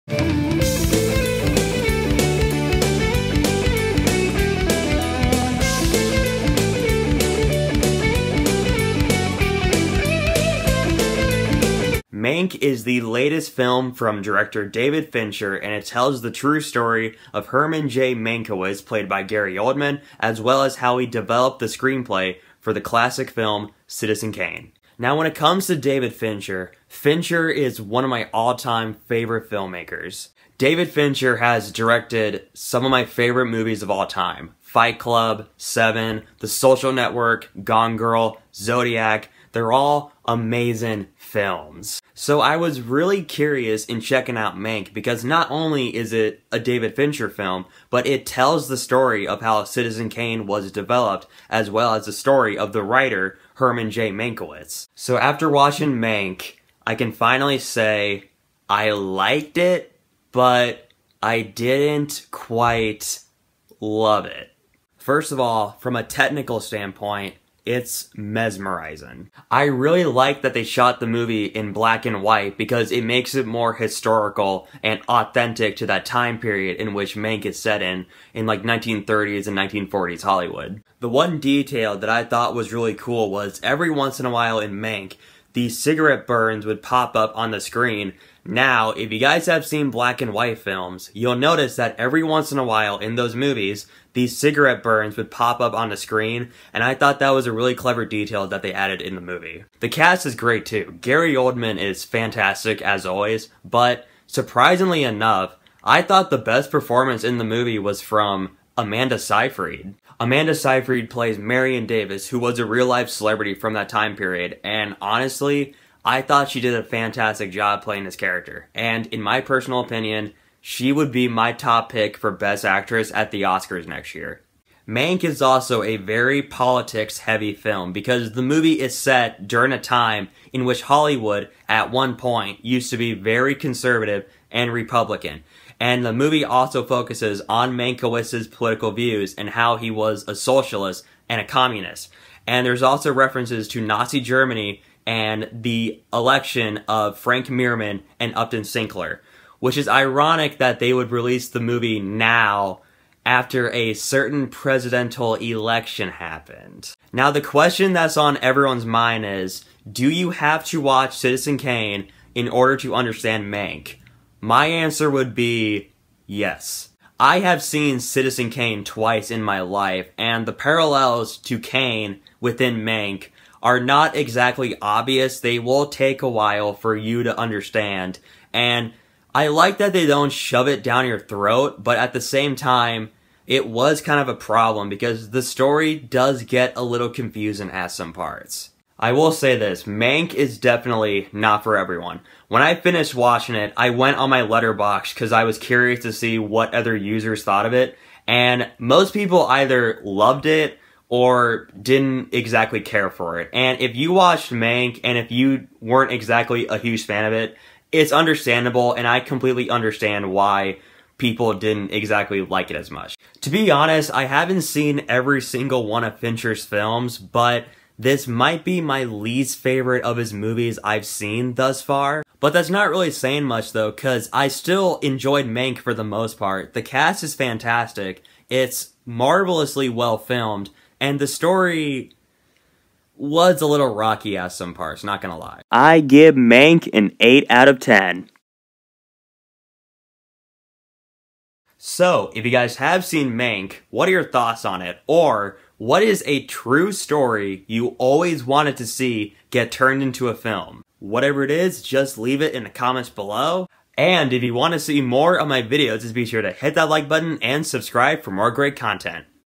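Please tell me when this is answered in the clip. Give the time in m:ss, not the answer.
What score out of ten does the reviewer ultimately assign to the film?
3:57.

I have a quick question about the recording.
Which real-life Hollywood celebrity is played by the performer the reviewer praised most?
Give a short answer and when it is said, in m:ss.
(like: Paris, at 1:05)
Marion Davies, at 1:51.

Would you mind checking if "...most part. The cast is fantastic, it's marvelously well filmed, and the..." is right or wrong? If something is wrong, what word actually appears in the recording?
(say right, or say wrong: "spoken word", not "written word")
right.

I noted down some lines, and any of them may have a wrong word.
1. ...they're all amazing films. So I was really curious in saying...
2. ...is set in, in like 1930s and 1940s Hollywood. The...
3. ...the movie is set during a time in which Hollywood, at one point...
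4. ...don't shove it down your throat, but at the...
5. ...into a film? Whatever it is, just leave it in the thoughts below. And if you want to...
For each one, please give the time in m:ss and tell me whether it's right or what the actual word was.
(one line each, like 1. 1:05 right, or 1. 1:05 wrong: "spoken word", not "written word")
1. 0:39 wrong: "checking", not "saying"
2. 1:17 right
3. 2:08 right
4. 3:00 right
5. 4:10 wrong: "comments", not "thoughts".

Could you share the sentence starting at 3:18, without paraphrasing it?
And most people either loved it or didn't exactly care for it.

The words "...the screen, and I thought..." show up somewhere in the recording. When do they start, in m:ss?
1:35.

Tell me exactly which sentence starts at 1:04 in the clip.
First of all, from a technical standpoint, it's mesmerizing.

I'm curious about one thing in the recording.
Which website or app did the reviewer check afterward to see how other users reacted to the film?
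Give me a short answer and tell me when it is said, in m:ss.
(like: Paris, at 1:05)
Letterboxd, at 3:14.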